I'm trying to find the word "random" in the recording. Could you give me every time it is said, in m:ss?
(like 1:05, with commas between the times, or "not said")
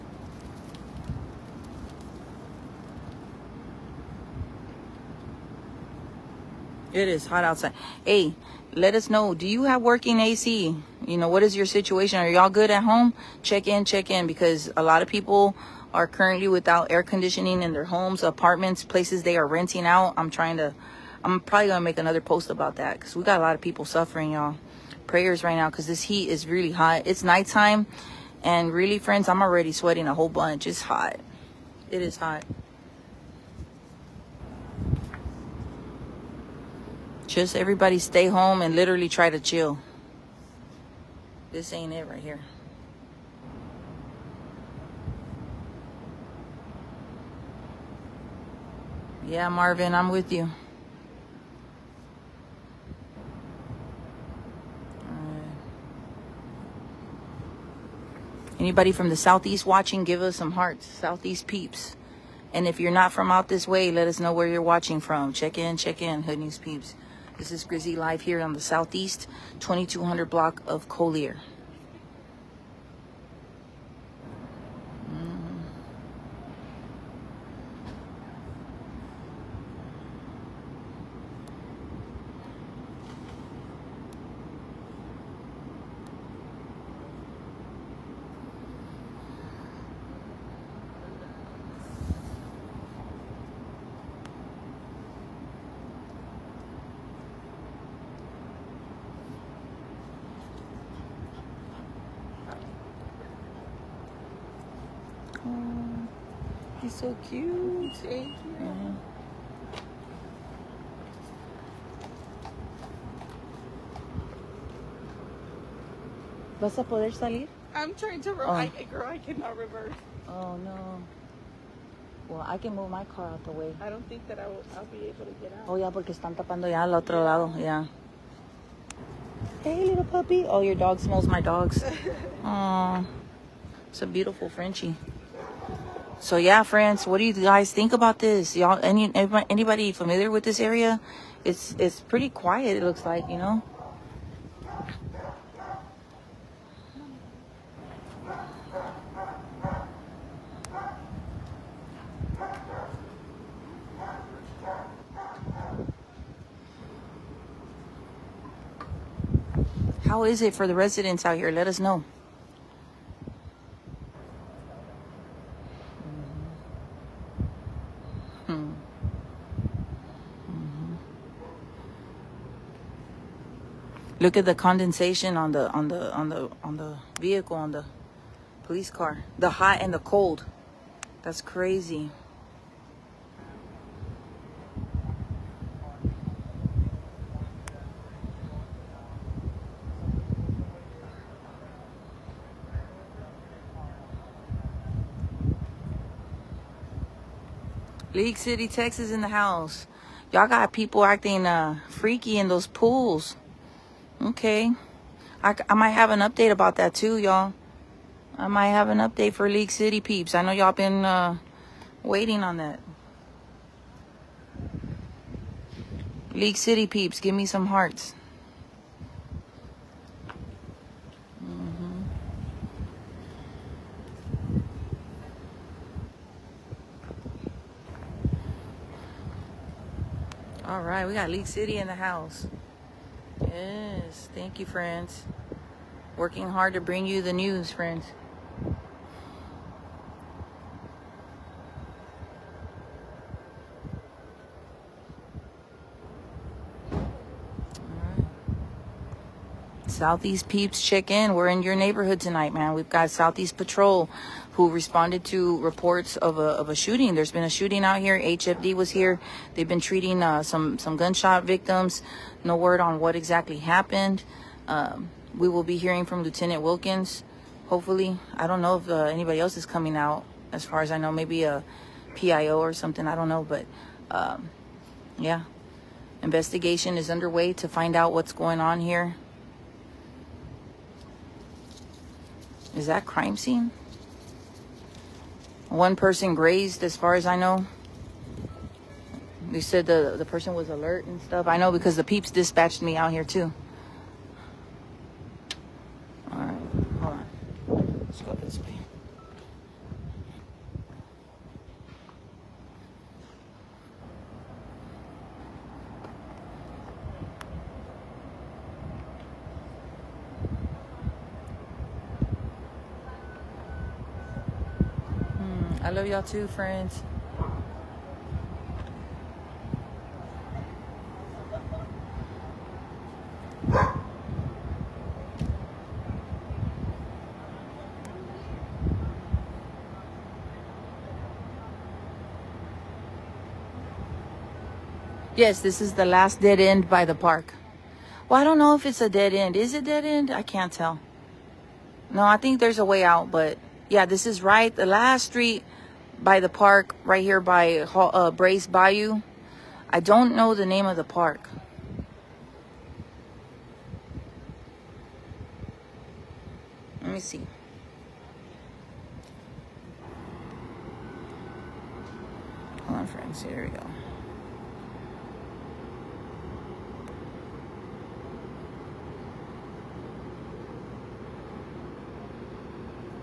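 not said.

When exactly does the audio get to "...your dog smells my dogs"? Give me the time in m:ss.
2:10.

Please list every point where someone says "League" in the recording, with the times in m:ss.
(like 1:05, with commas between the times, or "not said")
3:18, 3:29, 3:36, 3:51.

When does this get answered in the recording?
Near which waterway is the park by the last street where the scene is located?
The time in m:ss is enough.
5:48.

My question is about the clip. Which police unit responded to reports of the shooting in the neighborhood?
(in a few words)
Southeast Patrol.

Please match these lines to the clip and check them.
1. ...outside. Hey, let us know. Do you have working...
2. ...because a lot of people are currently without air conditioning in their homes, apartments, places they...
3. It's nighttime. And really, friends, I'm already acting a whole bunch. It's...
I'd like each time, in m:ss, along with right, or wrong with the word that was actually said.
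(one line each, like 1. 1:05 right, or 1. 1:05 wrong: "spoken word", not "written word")
1. 0:07 right
2. 0:14 right
3. 0:27 wrong: "sweating", not "acting".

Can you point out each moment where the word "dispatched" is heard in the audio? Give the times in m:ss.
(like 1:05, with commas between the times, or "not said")
4:52.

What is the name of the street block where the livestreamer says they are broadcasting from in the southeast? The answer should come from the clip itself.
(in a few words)
2200 block of Collier.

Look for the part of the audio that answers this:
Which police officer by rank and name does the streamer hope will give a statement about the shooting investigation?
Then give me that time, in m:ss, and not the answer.
4:26.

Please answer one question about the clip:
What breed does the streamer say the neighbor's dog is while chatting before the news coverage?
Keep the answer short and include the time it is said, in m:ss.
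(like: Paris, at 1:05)
Frenchie, at 2:14.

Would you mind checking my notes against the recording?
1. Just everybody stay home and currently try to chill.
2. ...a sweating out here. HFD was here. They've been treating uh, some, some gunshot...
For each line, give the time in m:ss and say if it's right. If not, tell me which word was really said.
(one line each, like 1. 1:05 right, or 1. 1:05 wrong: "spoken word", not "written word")
1. 0:37 wrong: "literally", not "currently"
2. 4:17 wrong: "shooting", not "sweating".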